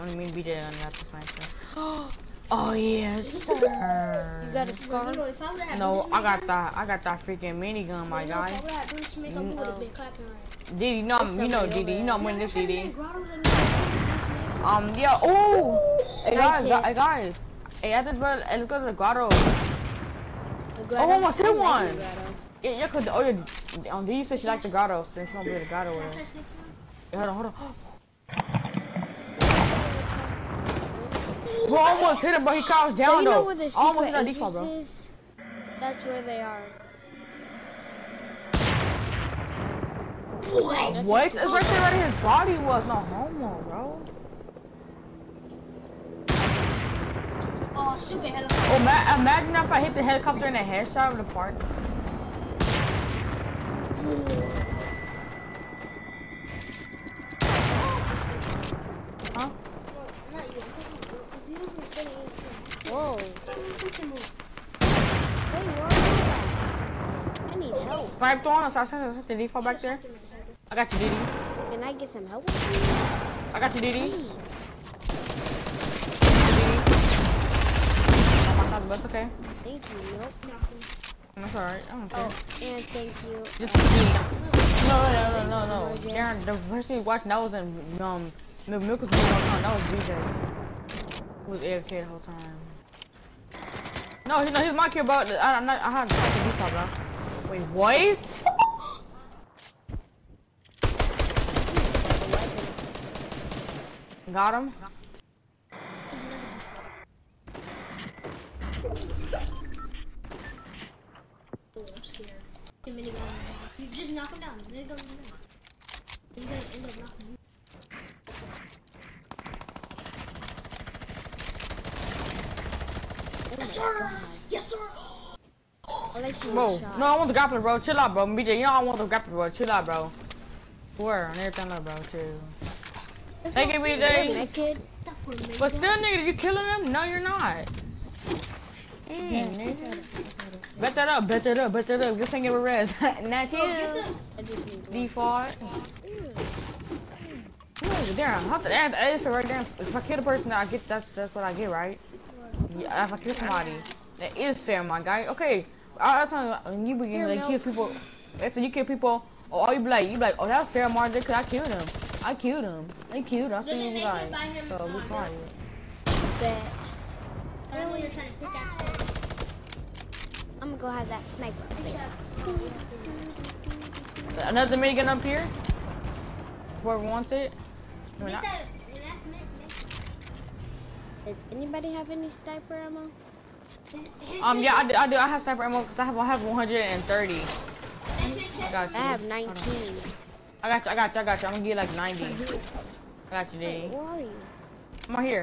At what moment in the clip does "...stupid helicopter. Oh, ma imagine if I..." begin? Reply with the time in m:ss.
0:47.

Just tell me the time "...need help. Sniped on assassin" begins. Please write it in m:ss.
1:07.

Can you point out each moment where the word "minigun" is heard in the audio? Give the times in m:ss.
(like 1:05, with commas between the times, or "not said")
0:07, 2:54.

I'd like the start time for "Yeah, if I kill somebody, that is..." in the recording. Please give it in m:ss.
2:32.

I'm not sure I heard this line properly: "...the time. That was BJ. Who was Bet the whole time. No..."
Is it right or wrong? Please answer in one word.
wrong.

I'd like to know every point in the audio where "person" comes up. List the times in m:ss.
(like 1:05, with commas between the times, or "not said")
1:26, 2:30.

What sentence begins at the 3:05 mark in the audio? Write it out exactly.
I have sniper ammo because I have, I have 130.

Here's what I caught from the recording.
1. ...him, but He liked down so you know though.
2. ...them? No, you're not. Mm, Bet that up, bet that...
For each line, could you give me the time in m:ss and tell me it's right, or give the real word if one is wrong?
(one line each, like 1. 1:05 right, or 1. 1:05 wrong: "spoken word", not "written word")
1. 0:32 wrong: "crouched", not "liked"
2. 2:16 right.